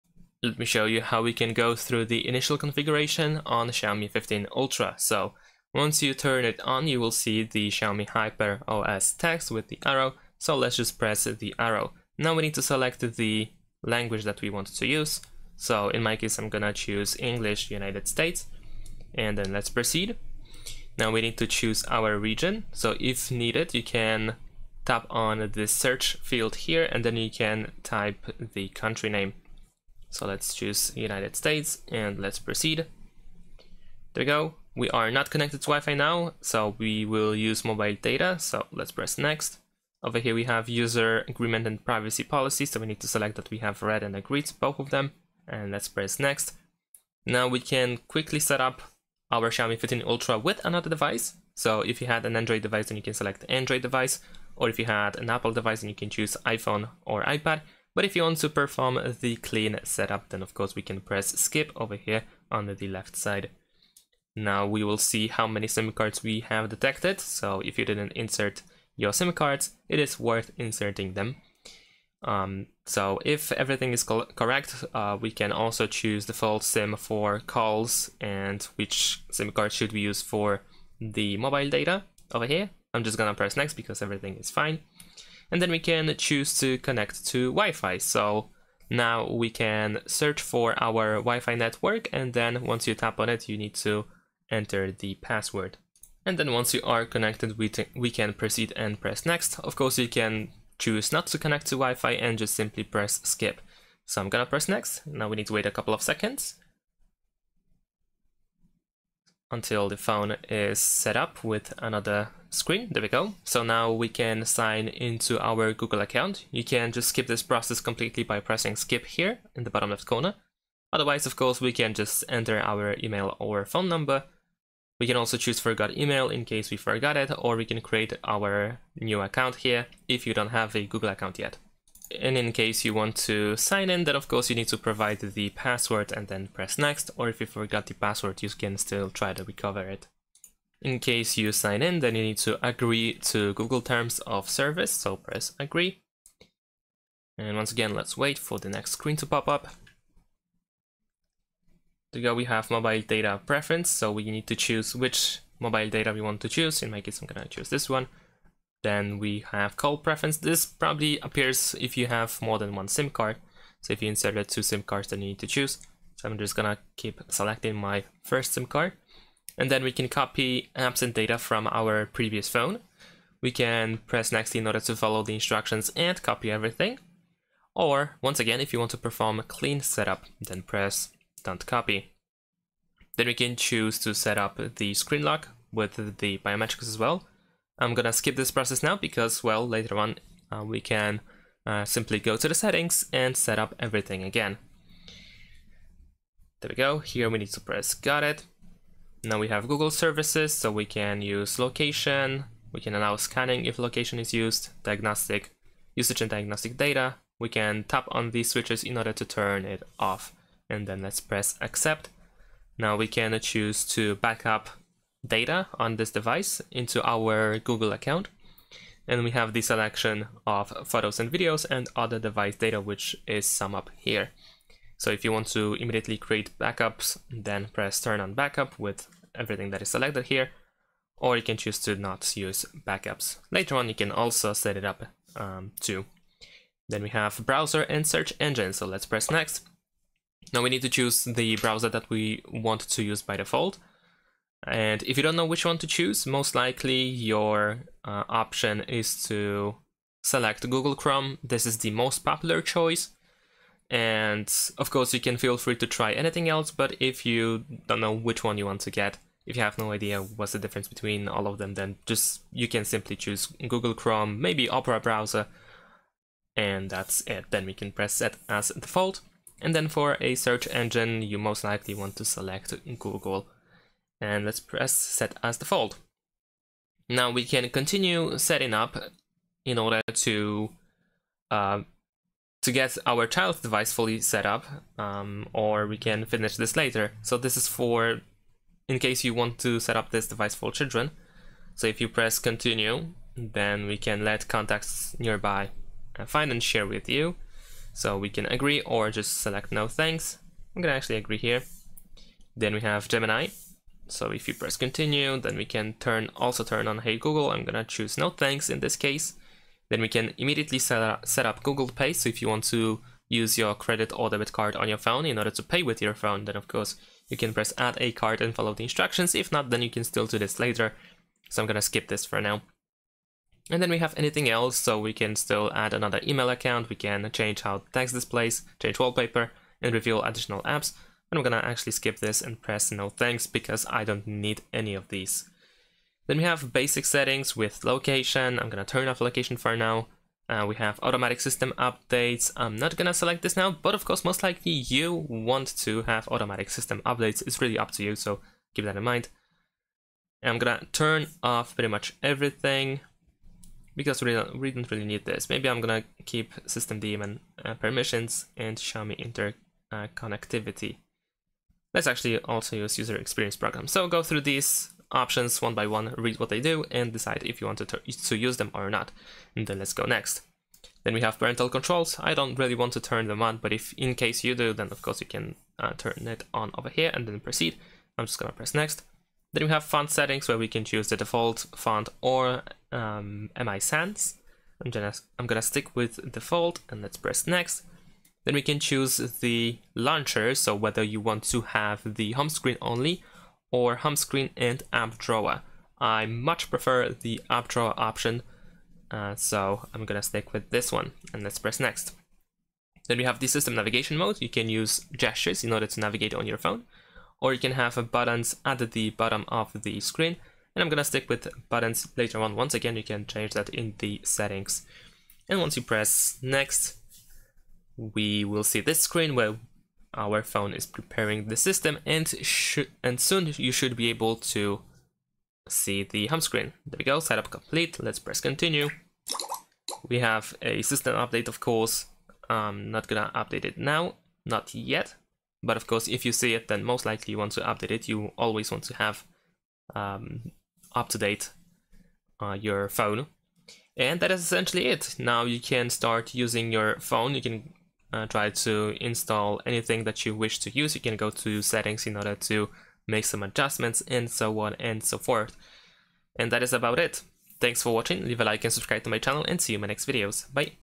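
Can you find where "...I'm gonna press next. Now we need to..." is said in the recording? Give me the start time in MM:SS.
01:44.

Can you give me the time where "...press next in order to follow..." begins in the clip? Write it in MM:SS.
02:53.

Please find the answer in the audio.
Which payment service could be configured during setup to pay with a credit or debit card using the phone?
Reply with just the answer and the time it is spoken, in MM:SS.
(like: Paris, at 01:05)
Google Pay, at 05:11.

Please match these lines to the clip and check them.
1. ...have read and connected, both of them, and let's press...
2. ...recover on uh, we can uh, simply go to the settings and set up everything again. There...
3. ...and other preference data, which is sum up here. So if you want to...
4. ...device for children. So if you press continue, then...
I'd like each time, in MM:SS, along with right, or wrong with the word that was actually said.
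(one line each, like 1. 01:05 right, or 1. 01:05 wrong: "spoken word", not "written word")
1. 00:43 wrong: "agreed", not "connected"
2. 03:09 wrong: "later", not "recover"
3. 03:41 wrong: "device", not "preference"
4. 04:50 right.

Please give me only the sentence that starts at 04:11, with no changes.
This is the most popular choice.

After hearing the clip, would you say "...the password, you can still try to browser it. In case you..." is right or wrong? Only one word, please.
wrong.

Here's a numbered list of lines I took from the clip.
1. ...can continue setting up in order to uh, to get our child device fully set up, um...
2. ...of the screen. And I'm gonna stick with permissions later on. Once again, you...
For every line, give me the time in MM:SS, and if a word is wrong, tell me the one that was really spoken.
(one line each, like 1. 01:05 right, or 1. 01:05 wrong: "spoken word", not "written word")
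1. 04:37 right
2. 06:49 wrong: "buttons", not "permissions".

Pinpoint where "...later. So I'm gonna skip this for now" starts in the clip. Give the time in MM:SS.
05:20.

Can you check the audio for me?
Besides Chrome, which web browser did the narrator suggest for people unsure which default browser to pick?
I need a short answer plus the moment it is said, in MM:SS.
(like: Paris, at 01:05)
Opera, at 04:24.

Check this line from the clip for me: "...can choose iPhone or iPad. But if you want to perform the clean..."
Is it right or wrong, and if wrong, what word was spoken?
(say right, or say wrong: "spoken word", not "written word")
right.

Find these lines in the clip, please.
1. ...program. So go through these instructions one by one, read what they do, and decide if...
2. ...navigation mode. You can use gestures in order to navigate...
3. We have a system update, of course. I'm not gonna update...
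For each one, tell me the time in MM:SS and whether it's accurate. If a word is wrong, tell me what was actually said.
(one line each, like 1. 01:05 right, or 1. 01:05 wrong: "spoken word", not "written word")
1. 06:03 wrong: "options", not "instructions"
2. 06:43 right
3. 07:10 right.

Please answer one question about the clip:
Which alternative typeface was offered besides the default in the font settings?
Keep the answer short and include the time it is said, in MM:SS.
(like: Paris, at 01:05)
MI Sans, at 06:23.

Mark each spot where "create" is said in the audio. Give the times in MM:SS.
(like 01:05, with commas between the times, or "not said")
02:07, 03:46.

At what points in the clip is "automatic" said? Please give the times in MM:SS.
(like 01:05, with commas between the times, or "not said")
05:41, 05:46.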